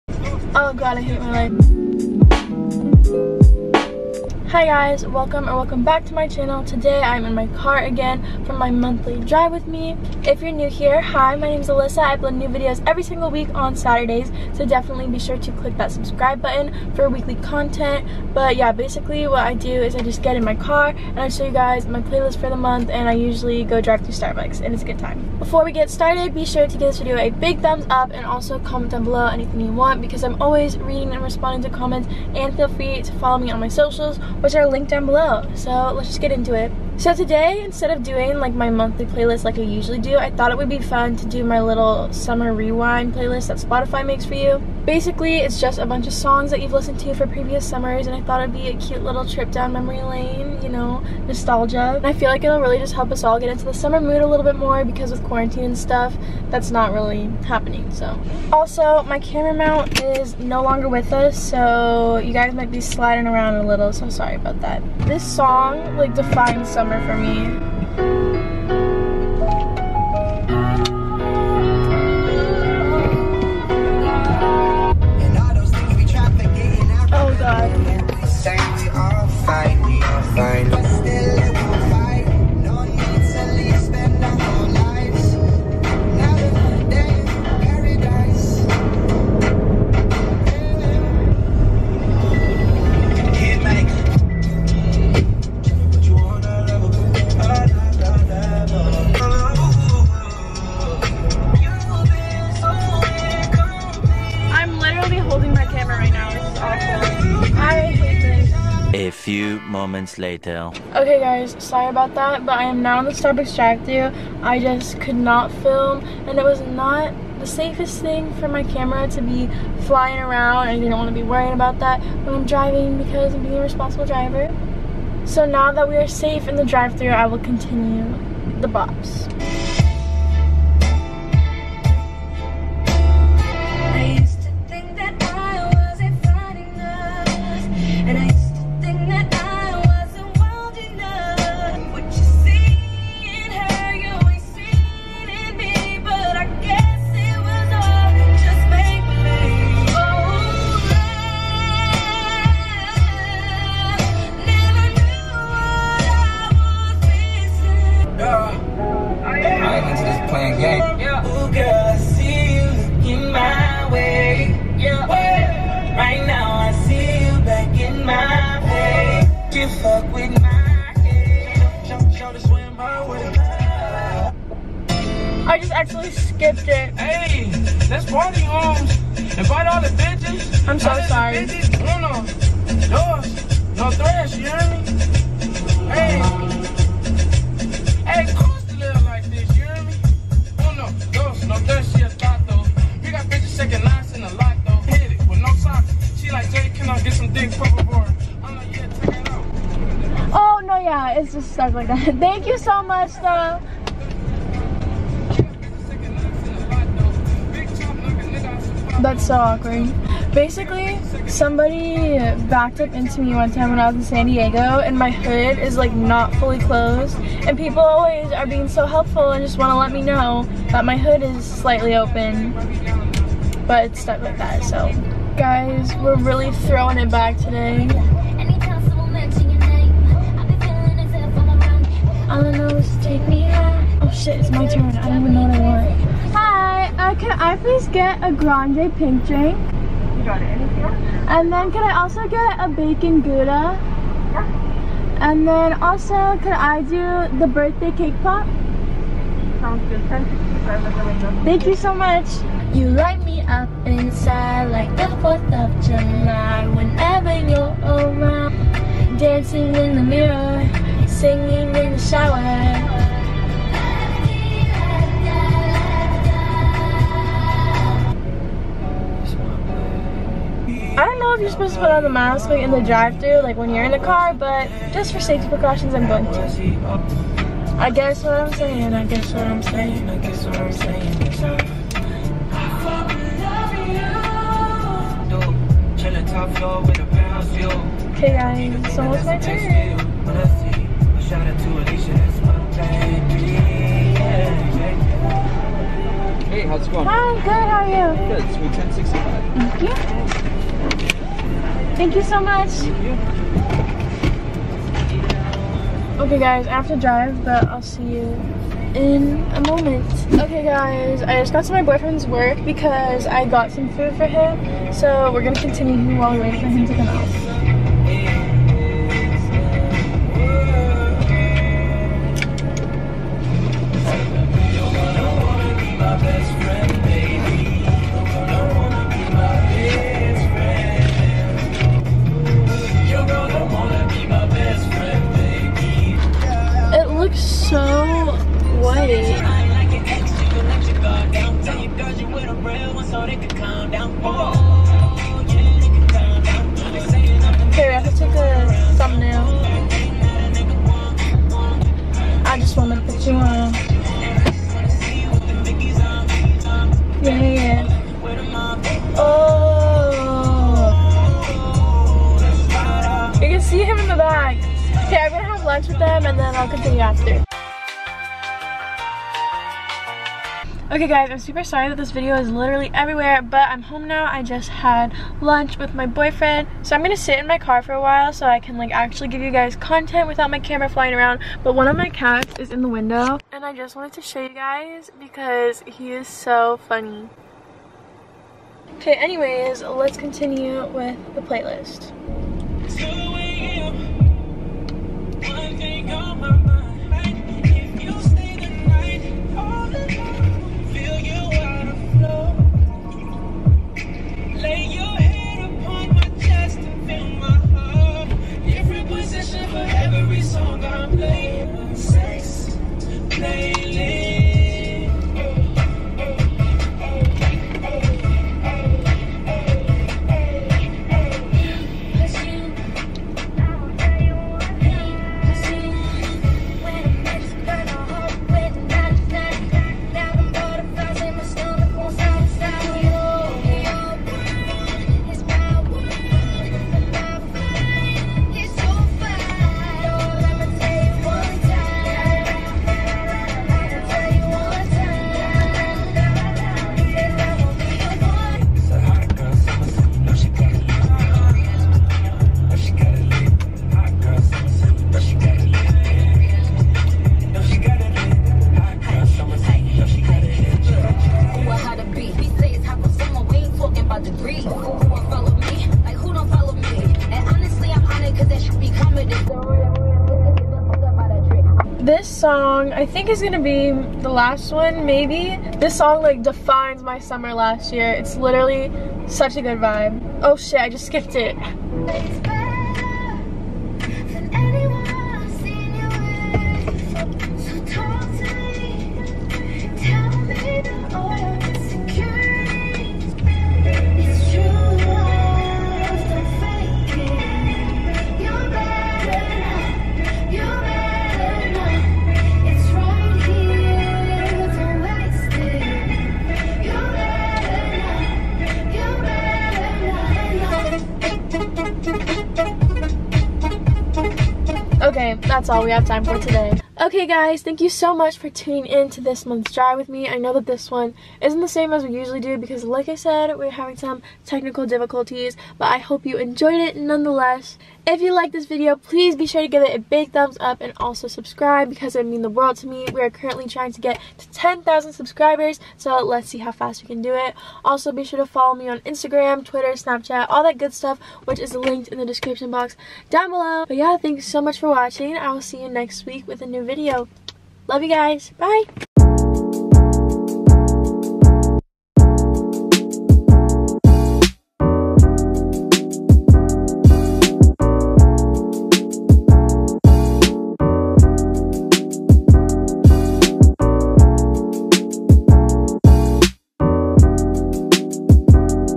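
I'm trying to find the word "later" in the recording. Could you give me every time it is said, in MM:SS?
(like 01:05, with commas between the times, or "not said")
01:50.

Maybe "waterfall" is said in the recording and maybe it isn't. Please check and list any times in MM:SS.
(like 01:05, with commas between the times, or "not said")
not said.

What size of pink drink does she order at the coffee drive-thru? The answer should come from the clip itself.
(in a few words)
Grande.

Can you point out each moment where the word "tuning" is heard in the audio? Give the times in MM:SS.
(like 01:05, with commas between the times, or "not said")
08:38.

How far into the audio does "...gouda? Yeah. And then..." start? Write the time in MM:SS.
04:03.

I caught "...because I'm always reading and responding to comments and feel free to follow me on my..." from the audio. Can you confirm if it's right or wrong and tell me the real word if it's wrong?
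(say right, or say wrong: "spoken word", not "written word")
right.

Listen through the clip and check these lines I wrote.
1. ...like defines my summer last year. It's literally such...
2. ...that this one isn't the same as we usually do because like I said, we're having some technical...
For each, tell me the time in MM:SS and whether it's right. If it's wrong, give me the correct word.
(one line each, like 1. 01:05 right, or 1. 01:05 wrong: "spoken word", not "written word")
1. 07:56 right
2. 08:40 right.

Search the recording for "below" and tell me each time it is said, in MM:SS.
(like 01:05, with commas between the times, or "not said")
00:29, 00:35, 09:03.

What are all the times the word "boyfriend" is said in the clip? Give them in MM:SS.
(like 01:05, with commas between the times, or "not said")
05:11, 06:16.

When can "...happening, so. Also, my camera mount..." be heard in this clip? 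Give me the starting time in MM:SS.
00:57.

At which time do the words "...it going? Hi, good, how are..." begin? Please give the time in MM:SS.
04:56.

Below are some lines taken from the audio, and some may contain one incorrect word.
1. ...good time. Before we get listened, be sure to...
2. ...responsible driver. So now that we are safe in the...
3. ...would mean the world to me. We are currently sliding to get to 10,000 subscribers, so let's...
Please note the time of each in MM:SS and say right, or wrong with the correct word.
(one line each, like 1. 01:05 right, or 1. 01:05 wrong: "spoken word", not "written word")
1. 00:24 wrong: "started", not "listened"
2. 02:03 right
3. 08:52 wrong: "trying", not "sliding".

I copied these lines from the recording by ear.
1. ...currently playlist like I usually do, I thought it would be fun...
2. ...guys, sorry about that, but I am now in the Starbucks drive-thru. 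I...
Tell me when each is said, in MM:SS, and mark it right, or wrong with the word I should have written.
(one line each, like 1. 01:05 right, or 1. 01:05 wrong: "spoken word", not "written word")
1. 00:38 wrong: "monthly", not "currently"
2. 01:51 right.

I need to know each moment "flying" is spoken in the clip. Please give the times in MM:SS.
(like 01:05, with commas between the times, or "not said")
01:59, 06:20.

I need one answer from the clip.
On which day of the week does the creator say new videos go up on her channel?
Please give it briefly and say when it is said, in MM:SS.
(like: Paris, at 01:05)
Saturdays, at 00:13.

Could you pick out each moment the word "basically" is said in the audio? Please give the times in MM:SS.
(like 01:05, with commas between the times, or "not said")
00:18, 00:44, 03:30.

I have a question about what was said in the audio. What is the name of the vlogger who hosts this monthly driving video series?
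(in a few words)
Alissa.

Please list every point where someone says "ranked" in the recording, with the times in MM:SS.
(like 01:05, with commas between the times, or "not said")
not said.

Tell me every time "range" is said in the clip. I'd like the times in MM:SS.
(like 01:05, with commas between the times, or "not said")
not said.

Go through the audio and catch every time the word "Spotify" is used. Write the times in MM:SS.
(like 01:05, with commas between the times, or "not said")
00:43.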